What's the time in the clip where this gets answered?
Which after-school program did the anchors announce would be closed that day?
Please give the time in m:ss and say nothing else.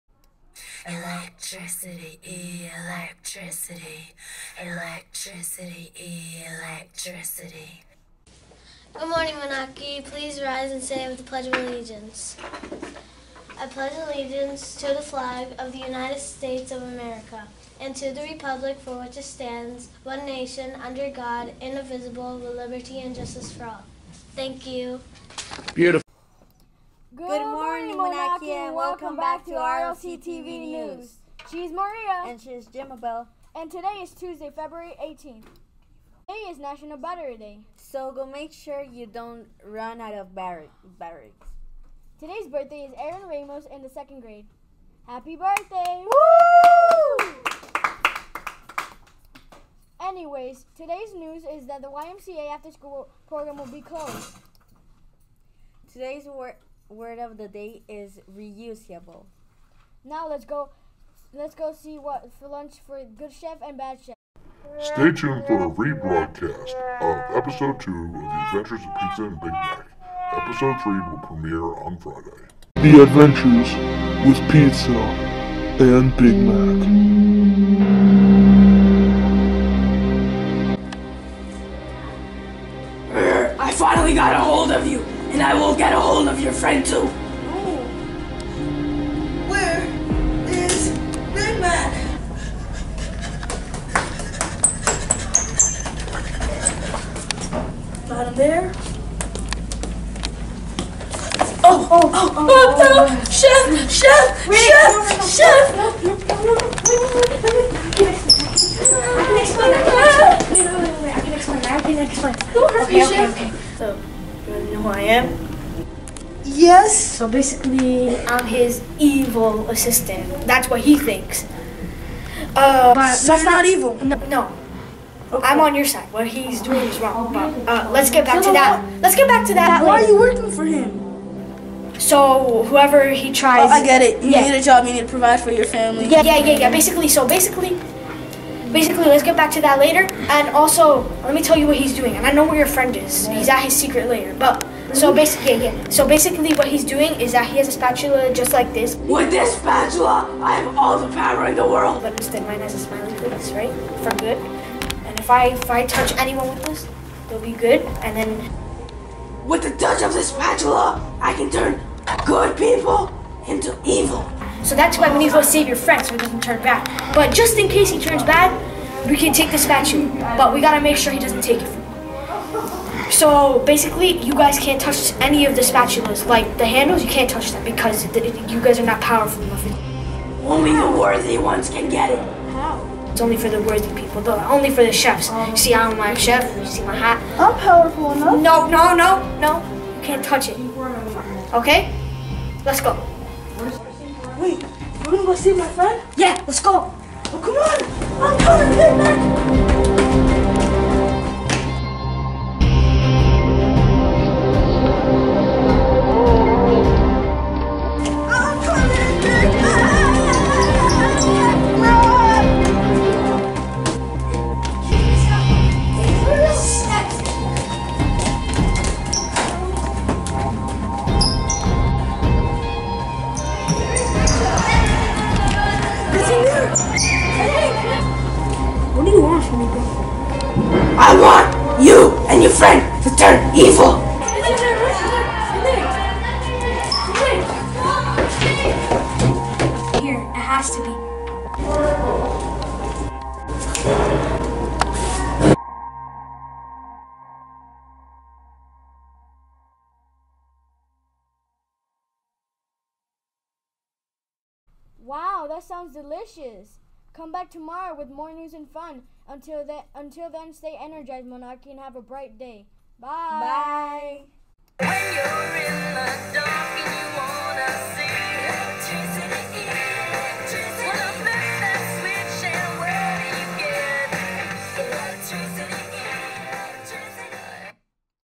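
0:51.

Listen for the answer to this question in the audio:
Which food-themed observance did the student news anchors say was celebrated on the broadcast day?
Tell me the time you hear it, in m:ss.
0:36.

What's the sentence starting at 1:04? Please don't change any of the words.
Stay tuned for a rebroadcast of episode 2 of The Adventures of Pizza and Big Mac.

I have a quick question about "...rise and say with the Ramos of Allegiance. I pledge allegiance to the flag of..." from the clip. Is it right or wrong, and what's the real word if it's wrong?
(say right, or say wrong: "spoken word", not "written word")
wrong: "Pledge", not "Ramos".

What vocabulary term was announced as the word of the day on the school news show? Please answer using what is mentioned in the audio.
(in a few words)
reusable.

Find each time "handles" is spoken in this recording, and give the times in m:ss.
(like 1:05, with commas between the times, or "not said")
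2:56.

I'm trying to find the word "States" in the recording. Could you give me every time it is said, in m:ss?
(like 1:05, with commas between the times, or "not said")
0:16.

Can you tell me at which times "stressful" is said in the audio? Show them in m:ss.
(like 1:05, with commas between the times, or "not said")
not said.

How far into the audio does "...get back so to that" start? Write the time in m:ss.
2:08.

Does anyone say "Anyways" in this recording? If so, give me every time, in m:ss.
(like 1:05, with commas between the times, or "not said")
0:50.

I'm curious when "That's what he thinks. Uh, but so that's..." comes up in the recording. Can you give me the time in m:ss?
2:00.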